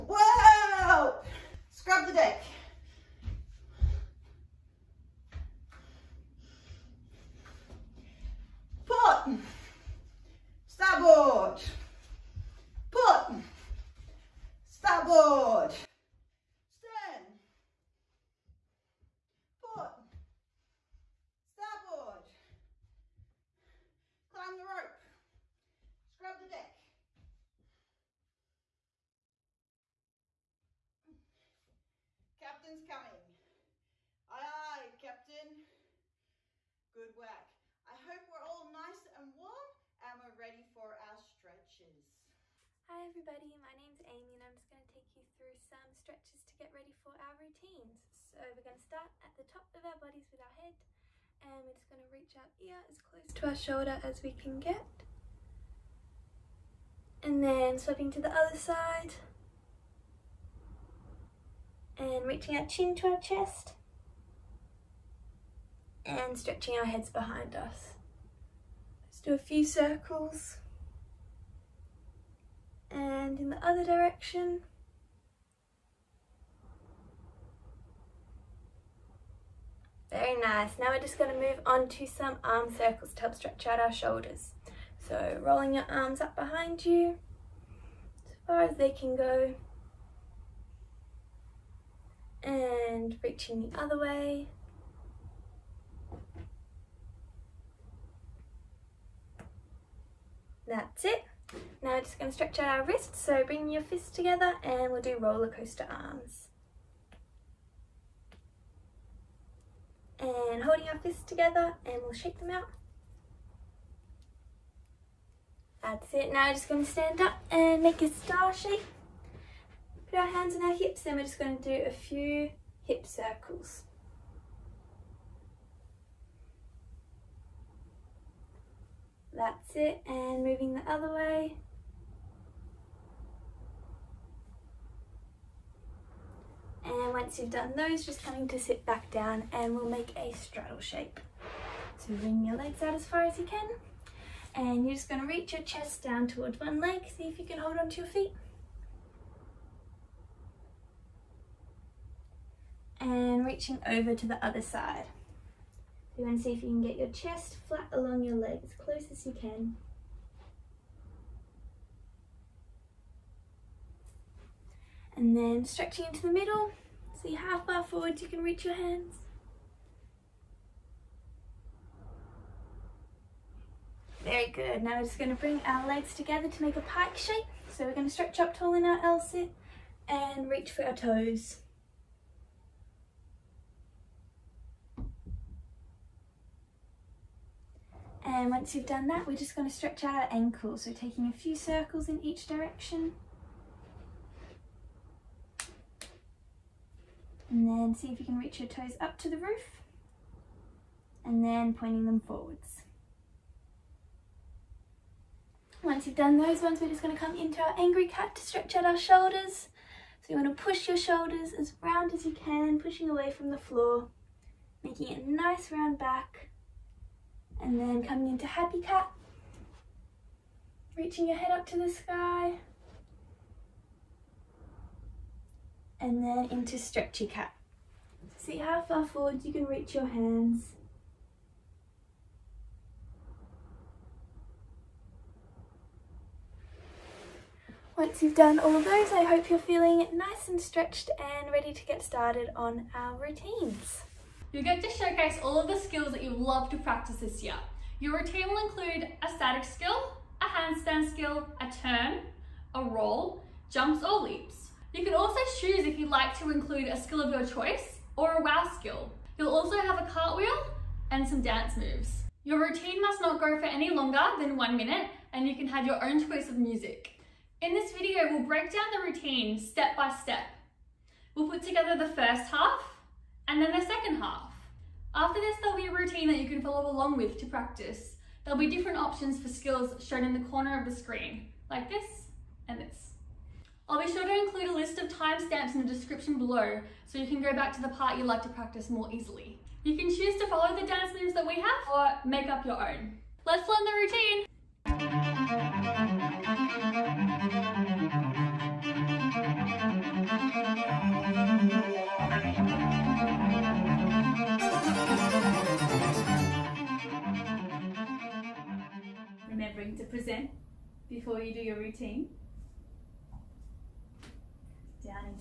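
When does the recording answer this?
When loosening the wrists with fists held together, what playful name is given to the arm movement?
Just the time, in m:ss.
1:45.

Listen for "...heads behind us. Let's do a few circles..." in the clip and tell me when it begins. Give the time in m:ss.
1:06.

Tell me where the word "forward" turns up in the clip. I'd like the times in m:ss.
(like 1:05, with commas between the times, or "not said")
2:47, 3:22, 3:49.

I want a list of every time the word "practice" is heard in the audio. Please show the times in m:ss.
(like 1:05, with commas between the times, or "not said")
4:06, 4:37, 4:48.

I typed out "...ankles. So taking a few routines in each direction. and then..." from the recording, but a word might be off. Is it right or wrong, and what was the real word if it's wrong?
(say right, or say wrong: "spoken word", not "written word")
wrong: "circles", not "routines".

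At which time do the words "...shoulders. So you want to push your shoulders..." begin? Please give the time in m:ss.
3:28.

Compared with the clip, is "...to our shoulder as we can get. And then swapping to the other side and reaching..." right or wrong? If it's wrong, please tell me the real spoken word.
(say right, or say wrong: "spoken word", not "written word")
right.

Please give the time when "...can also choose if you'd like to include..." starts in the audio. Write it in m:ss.
4:15.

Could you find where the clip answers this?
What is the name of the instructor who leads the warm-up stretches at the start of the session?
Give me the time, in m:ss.
0:44.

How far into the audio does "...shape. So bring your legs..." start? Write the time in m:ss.
2:20.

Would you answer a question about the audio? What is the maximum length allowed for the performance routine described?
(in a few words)
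1 minute.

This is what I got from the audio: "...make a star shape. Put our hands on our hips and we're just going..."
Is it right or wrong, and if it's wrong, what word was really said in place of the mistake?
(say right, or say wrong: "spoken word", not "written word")
right.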